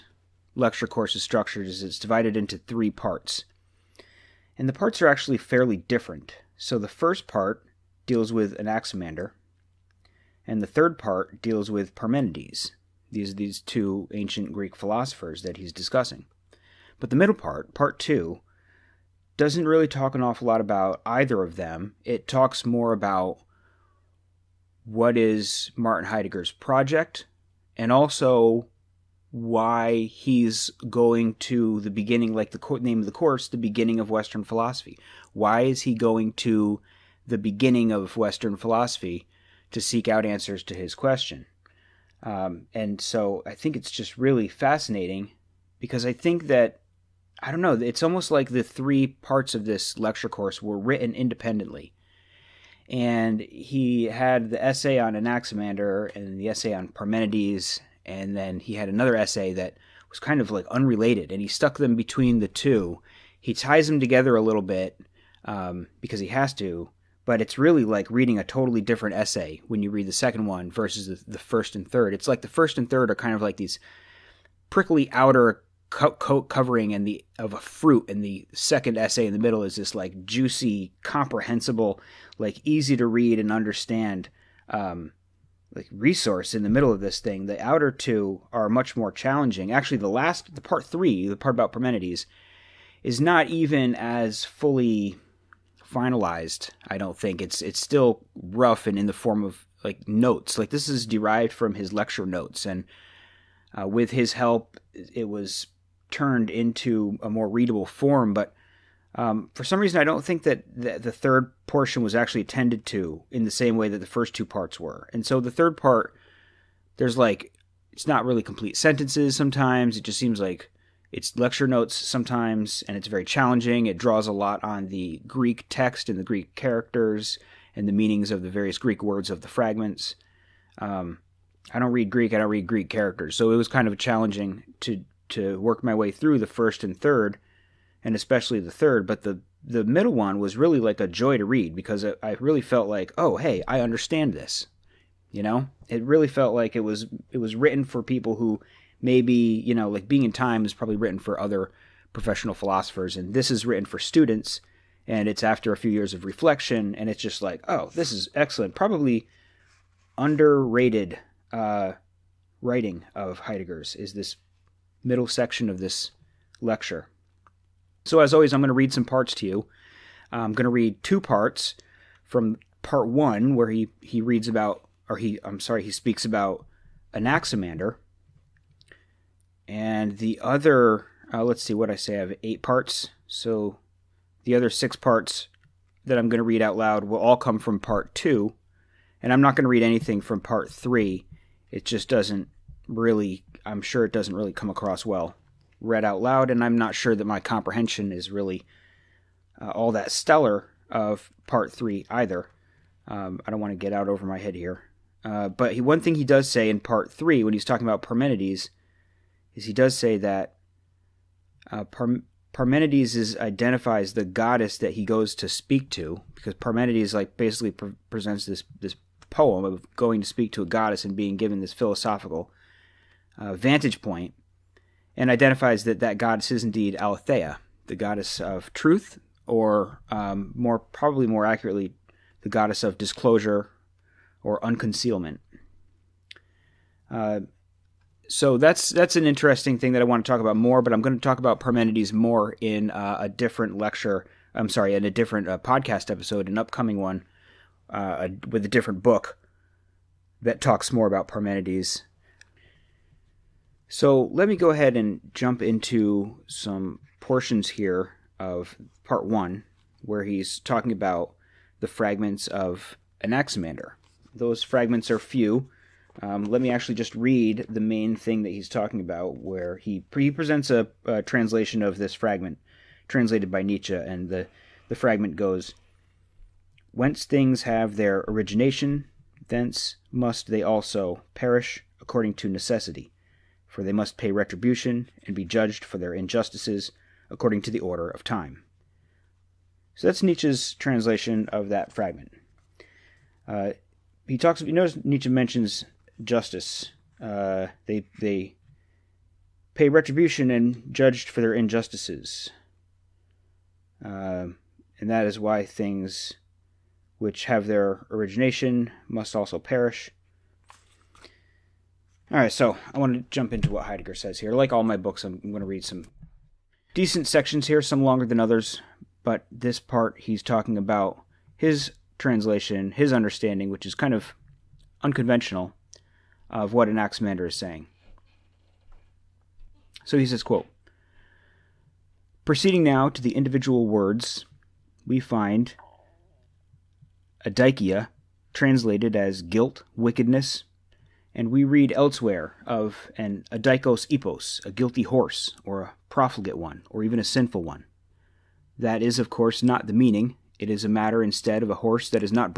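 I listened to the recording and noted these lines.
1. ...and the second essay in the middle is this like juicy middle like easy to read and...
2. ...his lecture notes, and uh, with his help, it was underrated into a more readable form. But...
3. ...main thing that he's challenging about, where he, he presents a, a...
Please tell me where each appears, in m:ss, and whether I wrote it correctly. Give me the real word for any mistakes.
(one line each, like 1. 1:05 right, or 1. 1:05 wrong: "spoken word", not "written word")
1. 1:18 wrong: "comprehensible", not "middle"
2. 1:41 wrong: "turned", not "underrated"
3. 4:27 wrong: "talking", not "challenging".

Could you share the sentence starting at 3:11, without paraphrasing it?
It just doesn't really, I'm sure it doesn't really come across well read out loud.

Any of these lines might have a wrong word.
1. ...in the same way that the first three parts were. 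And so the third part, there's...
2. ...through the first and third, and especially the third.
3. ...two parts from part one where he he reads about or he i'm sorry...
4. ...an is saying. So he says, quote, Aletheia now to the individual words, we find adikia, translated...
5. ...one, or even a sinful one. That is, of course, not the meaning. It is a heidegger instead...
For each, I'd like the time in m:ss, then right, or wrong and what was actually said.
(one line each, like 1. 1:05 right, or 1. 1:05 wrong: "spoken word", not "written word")
1. 1:53 wrong: "two", not "three"
2. 2:16 right
3. 2:51 right
4. 5:26 wrong: "Proceeding", not "Aletheia"
5. 5:46 wrong: "matter", not "heidegger".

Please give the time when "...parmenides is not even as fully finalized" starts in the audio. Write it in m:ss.
1:31.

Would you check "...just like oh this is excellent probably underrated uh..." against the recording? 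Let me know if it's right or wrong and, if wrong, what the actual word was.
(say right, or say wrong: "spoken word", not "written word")
right.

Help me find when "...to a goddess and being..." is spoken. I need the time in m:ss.
3:40.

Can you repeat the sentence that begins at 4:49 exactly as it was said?
So that's Nietzsche's translation of that fragment.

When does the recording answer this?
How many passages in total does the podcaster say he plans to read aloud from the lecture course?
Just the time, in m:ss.
3:02.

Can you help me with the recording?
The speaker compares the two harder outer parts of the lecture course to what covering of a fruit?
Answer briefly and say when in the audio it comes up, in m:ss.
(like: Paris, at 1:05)
prickly outer coat, at 1:14.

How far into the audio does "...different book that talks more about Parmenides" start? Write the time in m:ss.
4:08.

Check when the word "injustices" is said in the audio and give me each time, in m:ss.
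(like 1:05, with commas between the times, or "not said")
4:46, 5:01.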